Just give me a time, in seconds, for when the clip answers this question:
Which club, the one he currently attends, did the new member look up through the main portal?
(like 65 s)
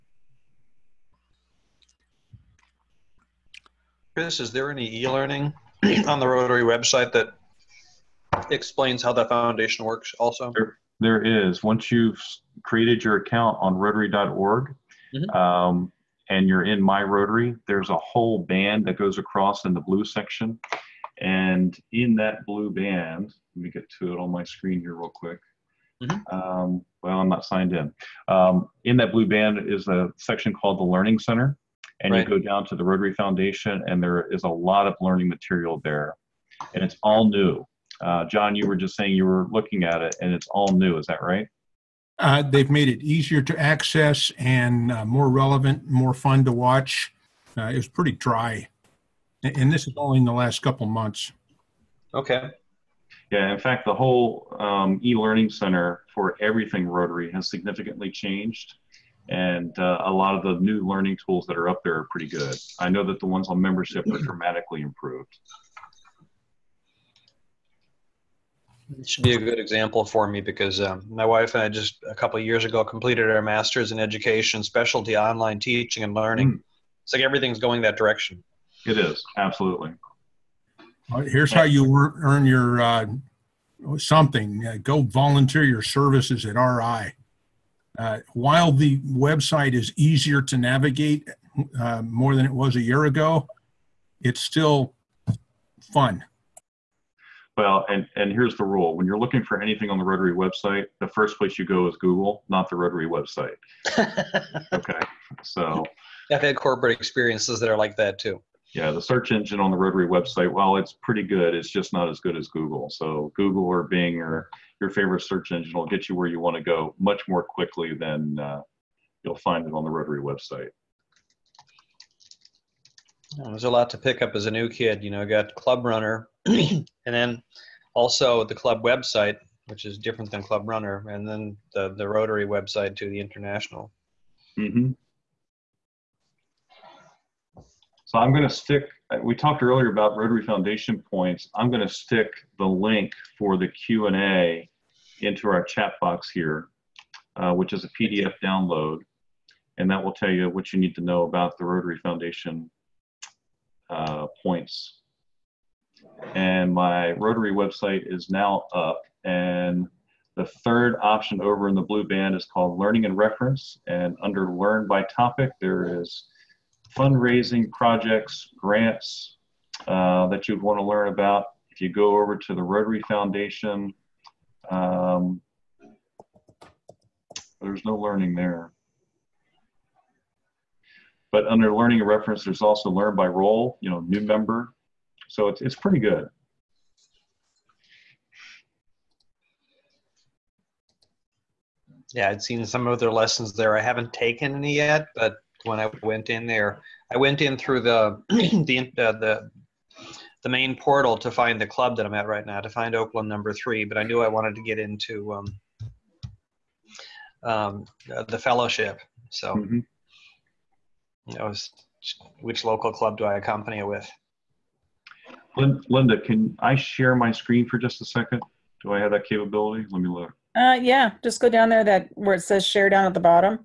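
202 s.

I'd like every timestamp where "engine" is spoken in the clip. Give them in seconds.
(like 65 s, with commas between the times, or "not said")
109 s, 115 s.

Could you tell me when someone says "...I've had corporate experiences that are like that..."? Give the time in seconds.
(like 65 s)
106 s.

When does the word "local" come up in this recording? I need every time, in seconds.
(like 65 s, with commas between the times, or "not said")
212 s.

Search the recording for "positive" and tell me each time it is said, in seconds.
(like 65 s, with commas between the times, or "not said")
not said.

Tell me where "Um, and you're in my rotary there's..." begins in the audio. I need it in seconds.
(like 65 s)
15 s.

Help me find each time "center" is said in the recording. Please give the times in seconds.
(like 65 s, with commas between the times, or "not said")
31 s, 55 s.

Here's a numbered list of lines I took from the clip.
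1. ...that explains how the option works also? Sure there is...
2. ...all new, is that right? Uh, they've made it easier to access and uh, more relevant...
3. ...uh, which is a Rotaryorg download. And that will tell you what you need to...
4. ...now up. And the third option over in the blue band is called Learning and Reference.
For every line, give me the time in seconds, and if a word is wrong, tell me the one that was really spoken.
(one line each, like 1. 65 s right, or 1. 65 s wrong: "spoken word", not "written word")
1. 7 s wrong: "foundation", not "option"
2. 40 s right
3. 147 s wrong: "PDF", not "Rotaryorg"
4. 158 s right.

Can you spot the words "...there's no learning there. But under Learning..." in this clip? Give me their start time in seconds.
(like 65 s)
177 s.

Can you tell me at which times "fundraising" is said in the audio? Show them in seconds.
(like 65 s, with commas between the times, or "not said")
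166 s.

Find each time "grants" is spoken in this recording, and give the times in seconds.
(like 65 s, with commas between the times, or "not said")
168 s.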